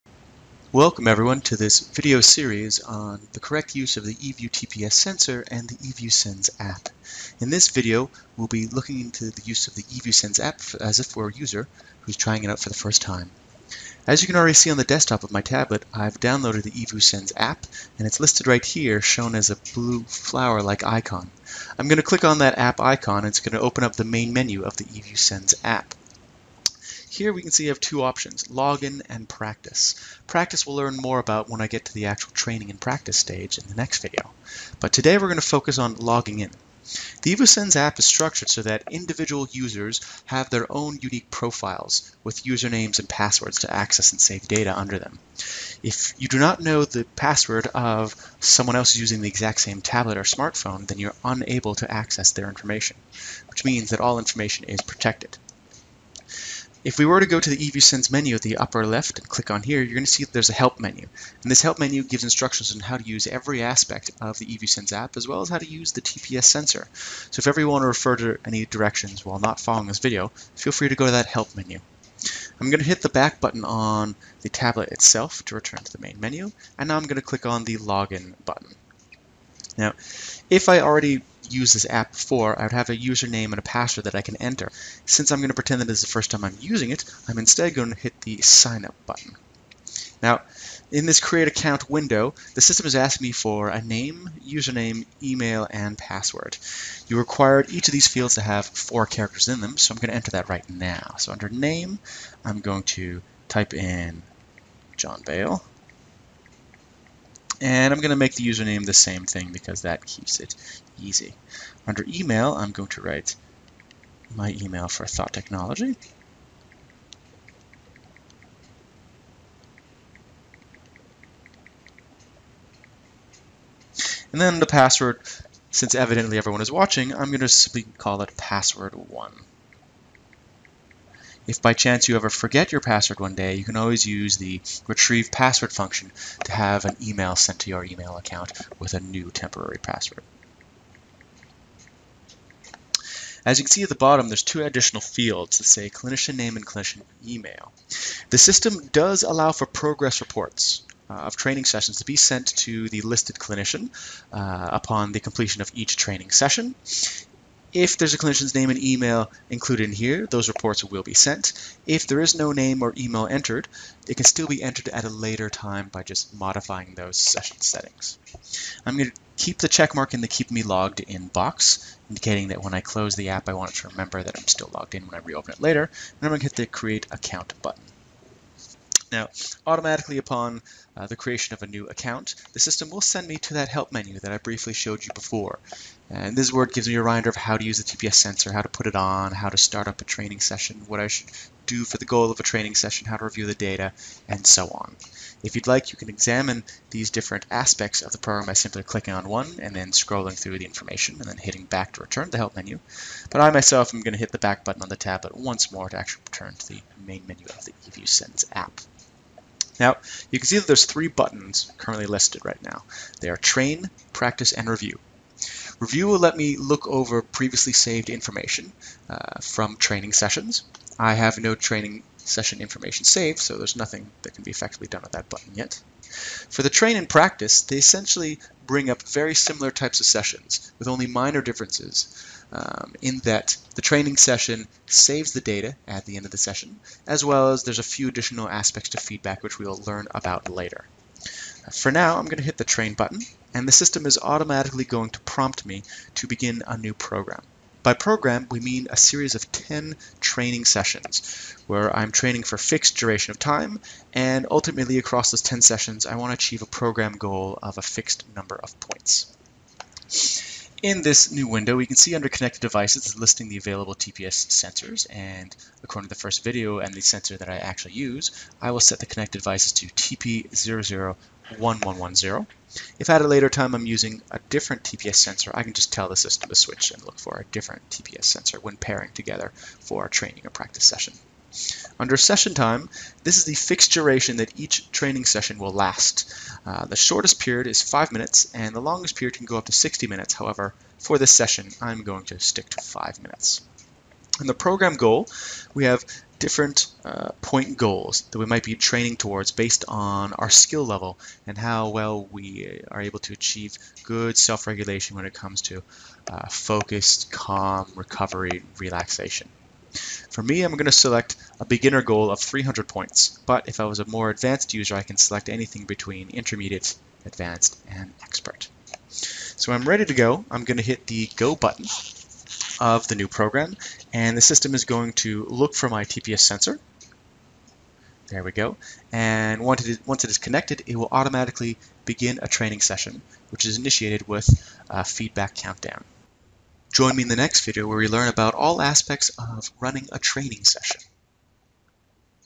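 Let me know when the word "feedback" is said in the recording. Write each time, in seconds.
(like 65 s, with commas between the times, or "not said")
238 s, 335 s.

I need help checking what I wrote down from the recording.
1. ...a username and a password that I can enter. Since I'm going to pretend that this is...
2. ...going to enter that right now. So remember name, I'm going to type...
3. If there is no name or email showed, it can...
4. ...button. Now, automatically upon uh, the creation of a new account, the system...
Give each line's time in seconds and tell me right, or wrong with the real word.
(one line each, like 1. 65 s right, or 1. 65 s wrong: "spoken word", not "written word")
1. 82 s right
2. 99 s wrong: "under", not "remember"
3. 161 s wrong: "entered", not "showed"
4. 177 s right.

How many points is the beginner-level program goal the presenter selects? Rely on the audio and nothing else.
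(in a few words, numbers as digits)
300.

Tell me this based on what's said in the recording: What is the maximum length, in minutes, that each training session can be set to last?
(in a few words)
60 minutes.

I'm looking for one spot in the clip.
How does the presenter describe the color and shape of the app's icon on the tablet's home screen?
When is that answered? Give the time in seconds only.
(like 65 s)
19 s.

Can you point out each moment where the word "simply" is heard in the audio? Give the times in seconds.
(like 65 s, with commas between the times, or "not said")
127 s, 198 s.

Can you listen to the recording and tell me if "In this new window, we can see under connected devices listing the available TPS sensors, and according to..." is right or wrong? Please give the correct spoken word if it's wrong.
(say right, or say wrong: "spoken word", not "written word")
right.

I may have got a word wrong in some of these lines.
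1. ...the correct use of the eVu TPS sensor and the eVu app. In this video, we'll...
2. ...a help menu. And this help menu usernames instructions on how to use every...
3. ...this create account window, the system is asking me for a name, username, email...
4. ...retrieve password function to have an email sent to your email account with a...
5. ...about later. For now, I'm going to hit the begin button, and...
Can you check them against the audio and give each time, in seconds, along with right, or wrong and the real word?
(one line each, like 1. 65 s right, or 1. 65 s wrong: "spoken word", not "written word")
1. 3 s right
2. 60 s wrong: "gives", not "usernames"
3. 91 s right
4. 134 s right
5. 240 s wrong: "train", not "begin".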